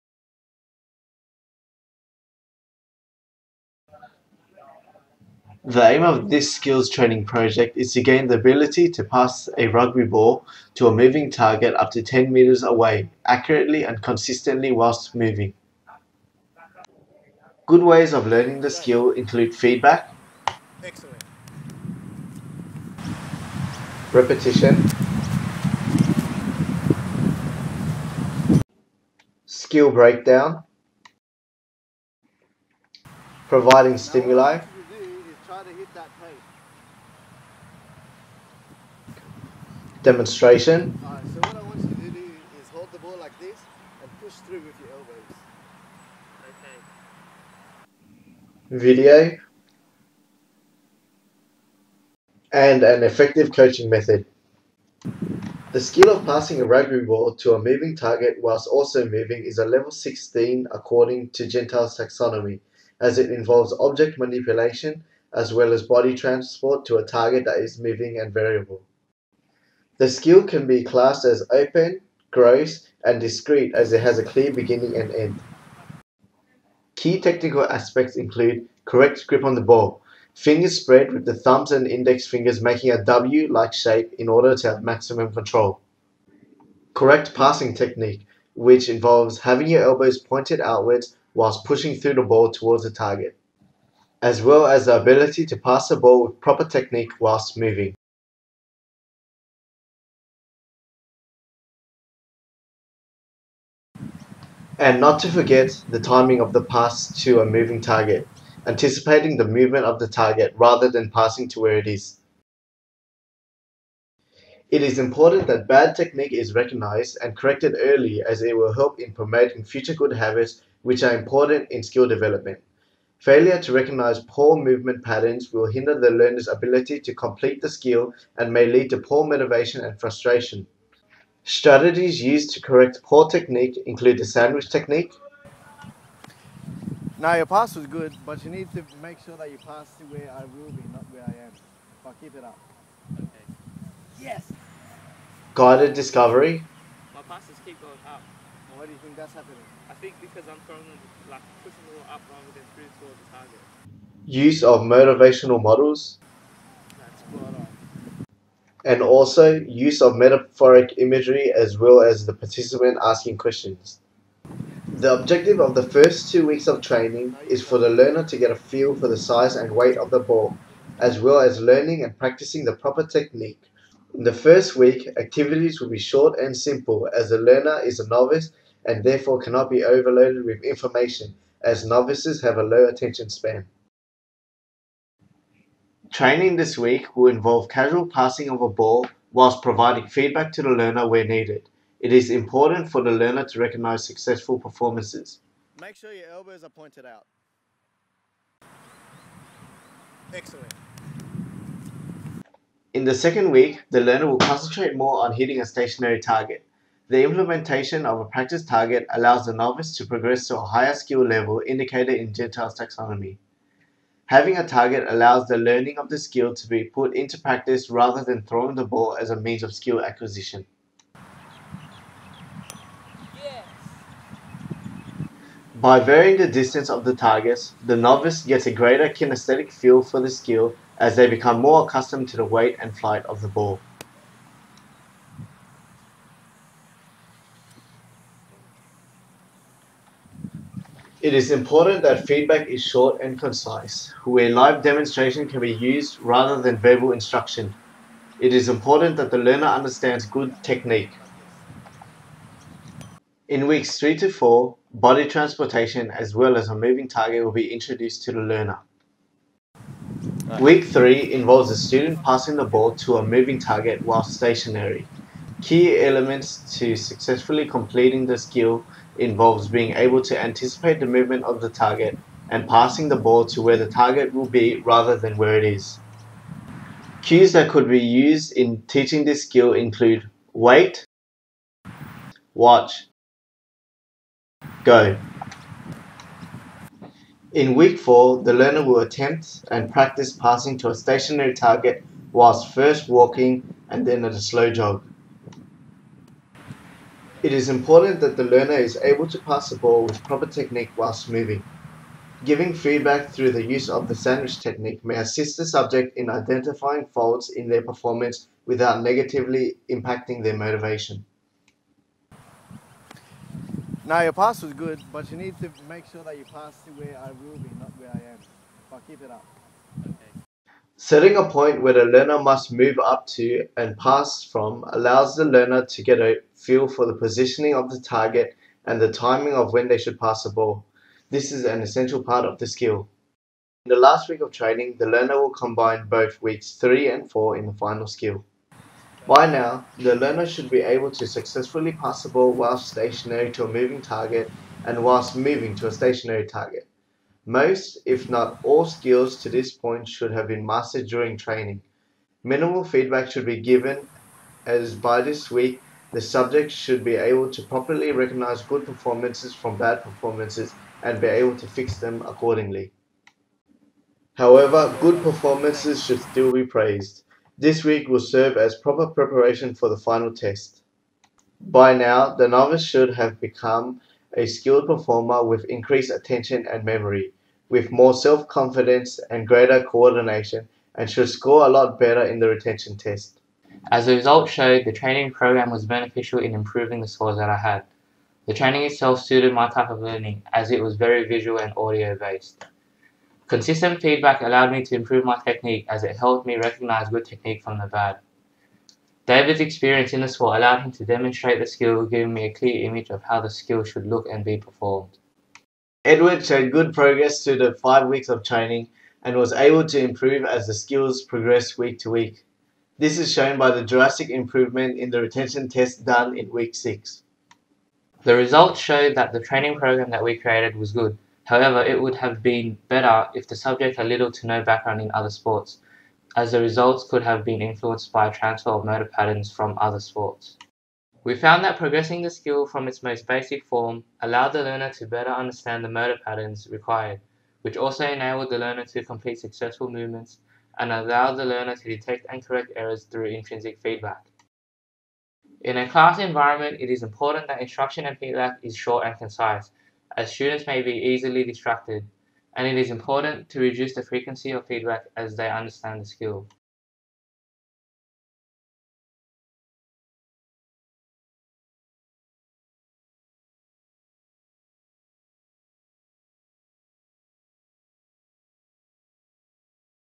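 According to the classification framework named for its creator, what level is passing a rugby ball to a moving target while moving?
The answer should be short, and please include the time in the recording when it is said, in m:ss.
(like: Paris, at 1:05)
Level 16, at 0:59.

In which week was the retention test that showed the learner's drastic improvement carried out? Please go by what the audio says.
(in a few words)
Week 6.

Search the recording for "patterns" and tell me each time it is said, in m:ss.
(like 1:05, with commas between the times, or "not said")
2:05, 7:09, 7:16.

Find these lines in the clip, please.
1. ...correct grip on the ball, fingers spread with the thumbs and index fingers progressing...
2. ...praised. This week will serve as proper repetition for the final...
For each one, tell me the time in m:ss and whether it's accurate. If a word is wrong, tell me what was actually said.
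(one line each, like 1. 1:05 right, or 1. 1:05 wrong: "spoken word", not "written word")
1. 1:18 wrong: "making", not "progressing"
2. 6:06 wrong: "preparation", not "repetition".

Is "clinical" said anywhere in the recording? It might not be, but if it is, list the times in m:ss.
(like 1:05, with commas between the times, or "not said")
not said.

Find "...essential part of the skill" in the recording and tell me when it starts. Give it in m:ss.
5:31.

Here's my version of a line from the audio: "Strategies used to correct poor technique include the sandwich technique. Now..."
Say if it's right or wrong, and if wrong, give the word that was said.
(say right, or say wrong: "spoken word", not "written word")
right.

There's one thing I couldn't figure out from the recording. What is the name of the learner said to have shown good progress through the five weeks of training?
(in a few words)
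Edward.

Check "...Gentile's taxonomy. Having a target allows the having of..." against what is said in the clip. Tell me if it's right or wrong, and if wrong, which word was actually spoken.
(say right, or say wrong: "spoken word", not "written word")
wrong: "learning", not "having".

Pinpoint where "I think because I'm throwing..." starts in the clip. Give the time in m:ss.
2:29.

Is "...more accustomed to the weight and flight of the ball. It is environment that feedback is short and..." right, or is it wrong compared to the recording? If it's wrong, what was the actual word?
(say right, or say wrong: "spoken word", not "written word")
wrong: "important", not "environment".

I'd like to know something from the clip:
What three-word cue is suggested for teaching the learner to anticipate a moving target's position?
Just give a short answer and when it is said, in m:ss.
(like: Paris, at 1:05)
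Wait, watch, go, at 4:40.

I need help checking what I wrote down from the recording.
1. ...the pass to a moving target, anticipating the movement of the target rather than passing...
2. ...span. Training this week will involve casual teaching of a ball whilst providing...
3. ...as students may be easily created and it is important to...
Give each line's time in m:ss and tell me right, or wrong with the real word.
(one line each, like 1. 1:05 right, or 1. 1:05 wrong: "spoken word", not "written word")
1. 1:46 right
2. 3:03 wrong: "passing", not "teaching"
3. 7:30 wrong: "distracted", not "created".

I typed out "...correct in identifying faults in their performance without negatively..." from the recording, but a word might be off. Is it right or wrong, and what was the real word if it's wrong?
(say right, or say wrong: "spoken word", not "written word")
wrong: "subject", not "correct".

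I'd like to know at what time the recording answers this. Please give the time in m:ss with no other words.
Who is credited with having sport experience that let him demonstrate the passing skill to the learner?
6:39.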